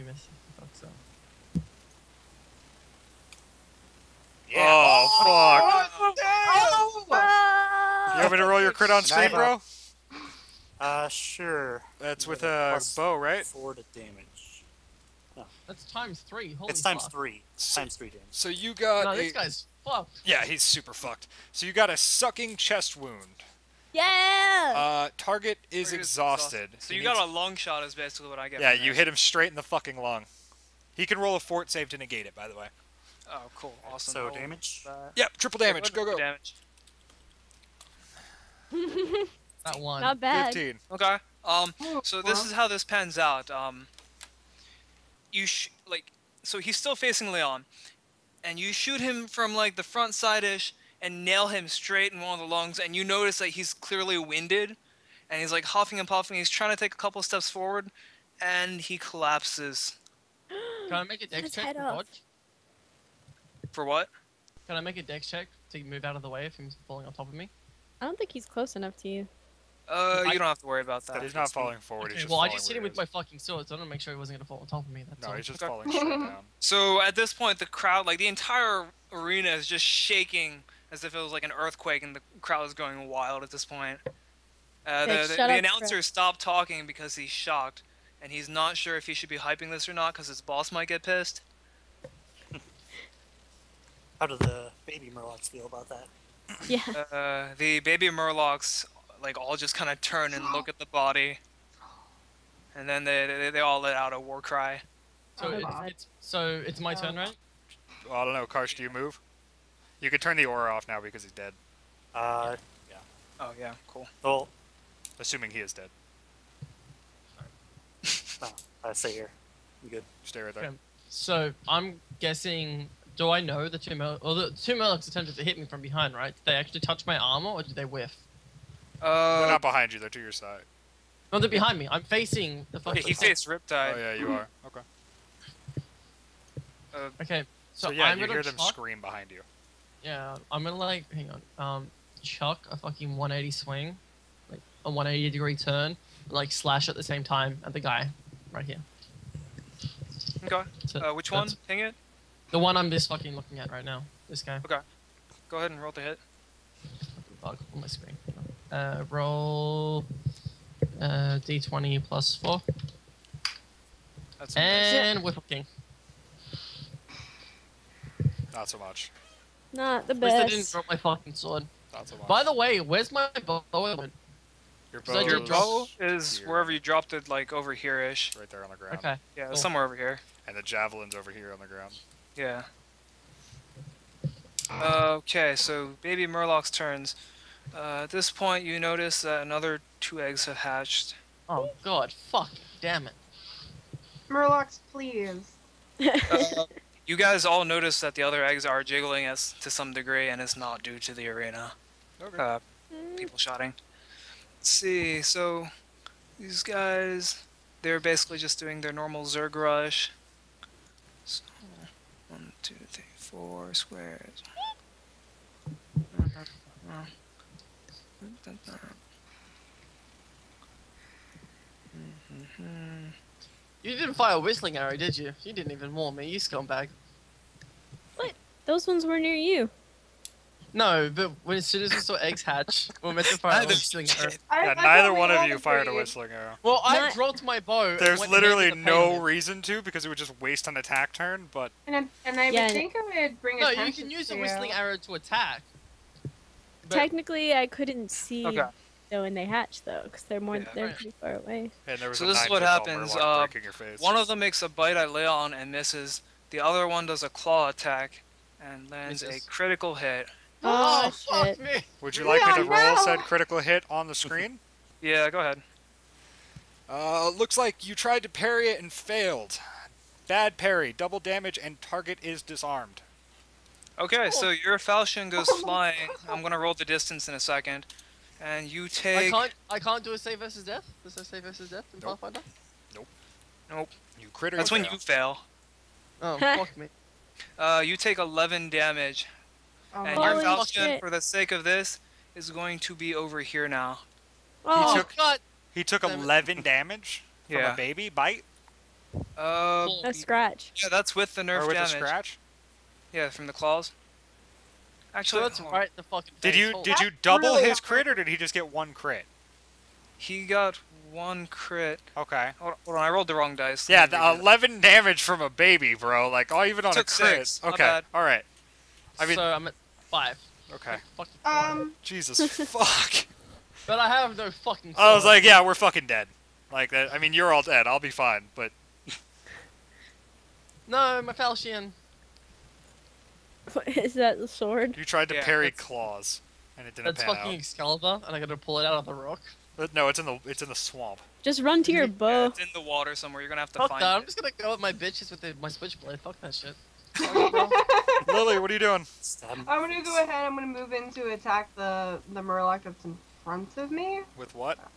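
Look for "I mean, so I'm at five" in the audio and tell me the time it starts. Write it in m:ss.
5:19.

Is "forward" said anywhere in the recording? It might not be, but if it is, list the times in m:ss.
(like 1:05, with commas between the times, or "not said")
0:57, 1:11.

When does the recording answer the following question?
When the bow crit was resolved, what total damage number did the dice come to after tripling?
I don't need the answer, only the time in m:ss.
0:40.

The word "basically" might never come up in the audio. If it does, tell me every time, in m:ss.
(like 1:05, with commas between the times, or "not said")
0:27, 3:28.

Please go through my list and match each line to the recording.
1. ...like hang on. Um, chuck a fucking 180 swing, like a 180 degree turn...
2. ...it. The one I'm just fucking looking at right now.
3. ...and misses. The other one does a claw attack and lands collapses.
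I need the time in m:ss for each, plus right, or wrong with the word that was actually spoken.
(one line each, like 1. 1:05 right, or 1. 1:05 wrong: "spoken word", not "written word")
1. 2:20 right
2. 2:31 right
3. 4:15 wrong: "misses", not "collapses".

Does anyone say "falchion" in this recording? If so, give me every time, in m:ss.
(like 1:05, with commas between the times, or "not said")
4:34, 4:50, 5:31.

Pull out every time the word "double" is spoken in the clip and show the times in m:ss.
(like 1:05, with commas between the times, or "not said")
4:30, 5:07.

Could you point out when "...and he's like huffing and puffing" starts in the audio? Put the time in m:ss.
0:55.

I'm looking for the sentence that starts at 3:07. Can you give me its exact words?
Uh, at this point, you notice that another two eggs have hatched.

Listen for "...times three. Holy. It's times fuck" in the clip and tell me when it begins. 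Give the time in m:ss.
0:15.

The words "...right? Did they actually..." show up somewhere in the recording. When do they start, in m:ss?
2:06.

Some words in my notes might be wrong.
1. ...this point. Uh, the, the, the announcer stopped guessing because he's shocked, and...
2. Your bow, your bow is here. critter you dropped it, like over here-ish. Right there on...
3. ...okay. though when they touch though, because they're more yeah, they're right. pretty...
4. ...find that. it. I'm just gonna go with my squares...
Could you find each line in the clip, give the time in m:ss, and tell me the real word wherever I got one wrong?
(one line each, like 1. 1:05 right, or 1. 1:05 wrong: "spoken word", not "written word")
1. 1:23 wrong: "talking", not "guessing"
2. 2:53 wrong: "wherever", not "critter"
3. 4:08 wrong: "hatch", not "touch"
4. 5:43 wrong: "bitches", not "squares".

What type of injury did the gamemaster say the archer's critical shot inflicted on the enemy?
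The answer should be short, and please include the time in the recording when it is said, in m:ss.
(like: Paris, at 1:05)
Sucking chest wound, at 0:21.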